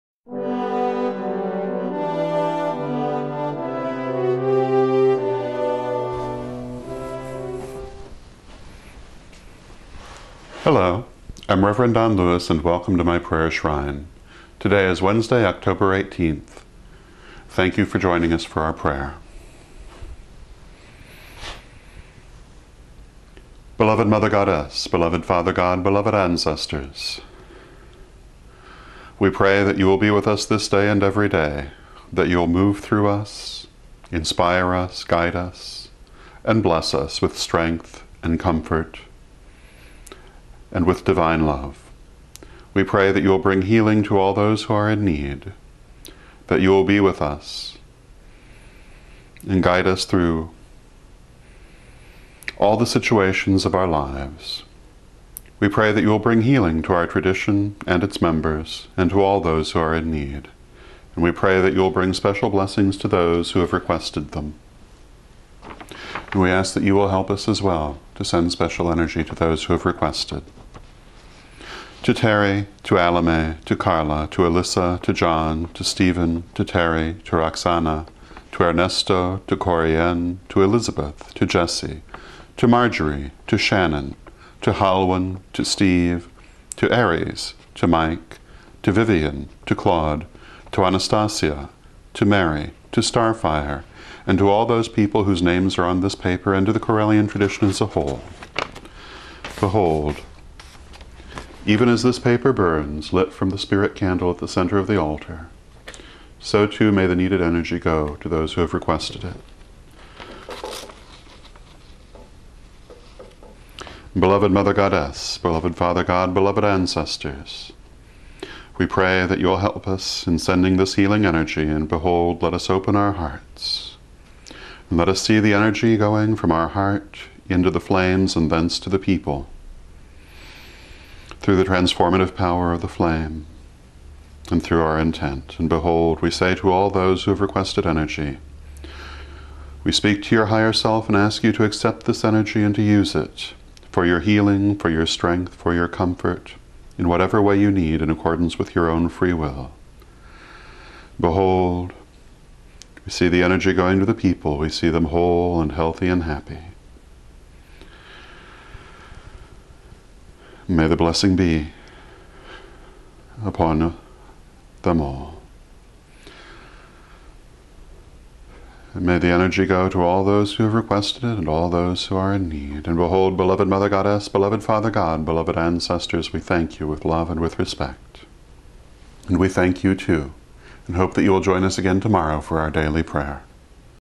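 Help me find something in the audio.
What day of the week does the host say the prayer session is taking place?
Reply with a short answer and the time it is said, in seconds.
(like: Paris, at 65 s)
Wednesday, at 15 s.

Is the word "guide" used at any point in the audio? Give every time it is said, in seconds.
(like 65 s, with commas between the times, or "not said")
35 s, 49 s.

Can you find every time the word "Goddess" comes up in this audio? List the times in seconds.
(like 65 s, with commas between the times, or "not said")
24 s, 114 s, 173 s.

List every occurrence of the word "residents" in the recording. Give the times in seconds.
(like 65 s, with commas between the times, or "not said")
not said.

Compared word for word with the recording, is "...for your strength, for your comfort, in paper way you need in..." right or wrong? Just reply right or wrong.
wrong.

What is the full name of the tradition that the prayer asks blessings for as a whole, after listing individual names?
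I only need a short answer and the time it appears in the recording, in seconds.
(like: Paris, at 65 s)
Correllian tradition, at 96 s.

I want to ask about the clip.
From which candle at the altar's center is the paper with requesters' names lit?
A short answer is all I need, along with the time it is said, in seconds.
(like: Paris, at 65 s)
Spirit candle, at 103 s.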